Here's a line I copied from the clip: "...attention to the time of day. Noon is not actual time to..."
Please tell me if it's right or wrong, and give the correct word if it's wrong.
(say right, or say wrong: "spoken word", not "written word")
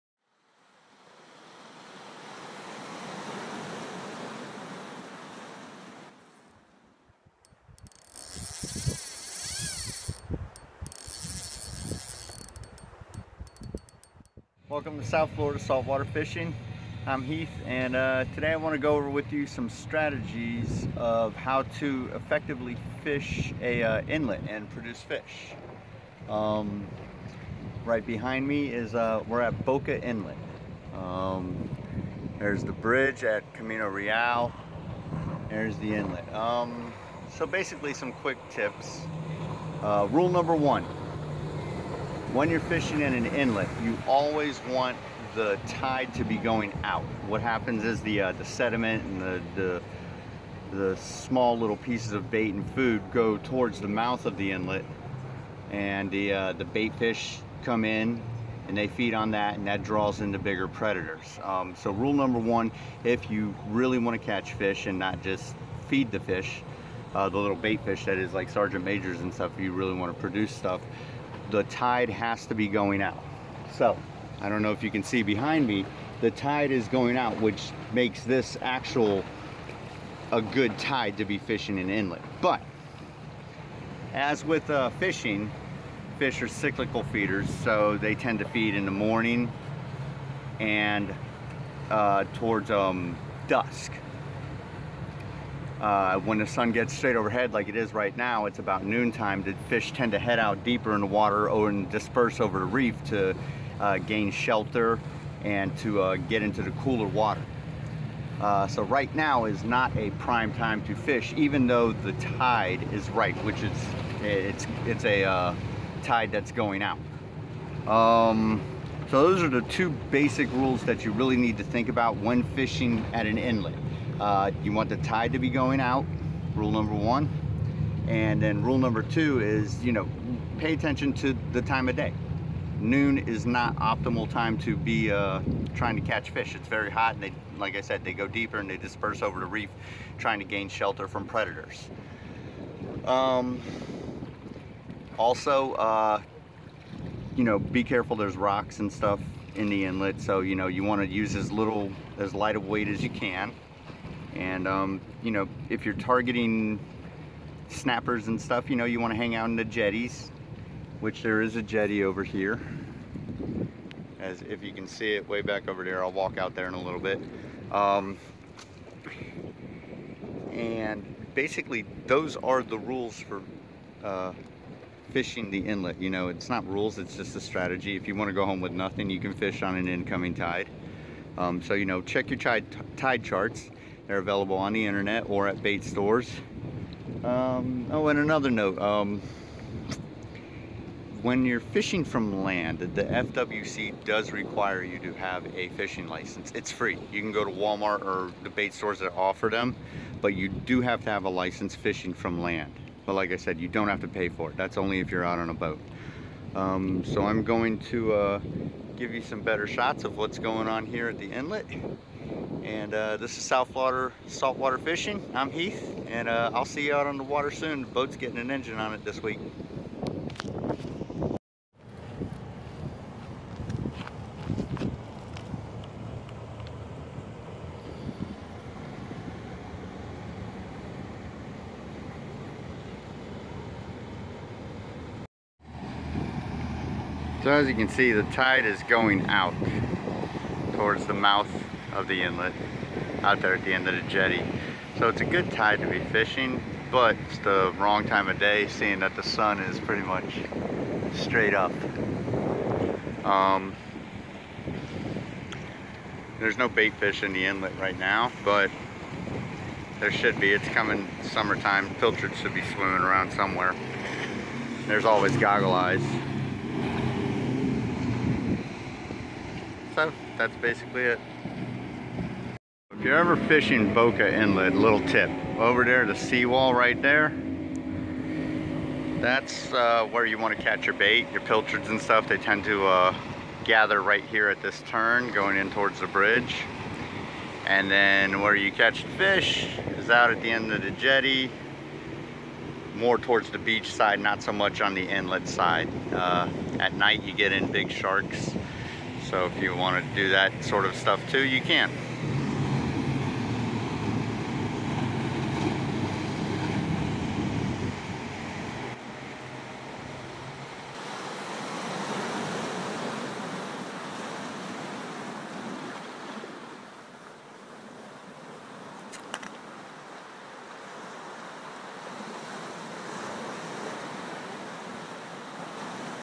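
wrong: "optimal", not "actual".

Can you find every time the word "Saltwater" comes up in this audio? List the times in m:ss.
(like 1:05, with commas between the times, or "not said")
0:15, 3:34.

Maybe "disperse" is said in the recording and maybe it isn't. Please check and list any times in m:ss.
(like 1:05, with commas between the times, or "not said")
1:41, 2:18.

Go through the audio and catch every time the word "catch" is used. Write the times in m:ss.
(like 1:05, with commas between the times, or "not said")
1:04, 2:16, 4:40, 4:48.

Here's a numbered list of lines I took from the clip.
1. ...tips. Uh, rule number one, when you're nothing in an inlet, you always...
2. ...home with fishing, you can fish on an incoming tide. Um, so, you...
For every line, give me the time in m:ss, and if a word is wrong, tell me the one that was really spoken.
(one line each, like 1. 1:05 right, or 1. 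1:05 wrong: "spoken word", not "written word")
1. 0:38 wrong: "fishing", not "nothing"
2. 2:58 wrong: "nothing", not "fishing".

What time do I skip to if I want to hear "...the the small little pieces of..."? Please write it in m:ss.
0:49.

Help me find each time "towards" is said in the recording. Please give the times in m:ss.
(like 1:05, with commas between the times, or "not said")
0:53, 1:32, 4:00, 4:45, 4:53.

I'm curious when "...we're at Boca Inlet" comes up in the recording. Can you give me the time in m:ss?
0:29.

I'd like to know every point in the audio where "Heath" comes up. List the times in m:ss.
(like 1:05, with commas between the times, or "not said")
0:17, 3:35.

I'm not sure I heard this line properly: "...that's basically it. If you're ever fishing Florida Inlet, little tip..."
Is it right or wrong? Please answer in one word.
wrong.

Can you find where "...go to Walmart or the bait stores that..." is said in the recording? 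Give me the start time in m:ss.
3:17.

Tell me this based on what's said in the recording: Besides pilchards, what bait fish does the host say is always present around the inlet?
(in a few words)
goggle eyes.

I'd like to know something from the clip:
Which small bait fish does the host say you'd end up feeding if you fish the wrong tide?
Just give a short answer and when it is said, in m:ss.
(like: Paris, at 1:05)
sergeant majors, at 1:08.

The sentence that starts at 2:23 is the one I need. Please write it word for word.
Um, also, uh, you know, be careful there's rocks and stuff in the inlet.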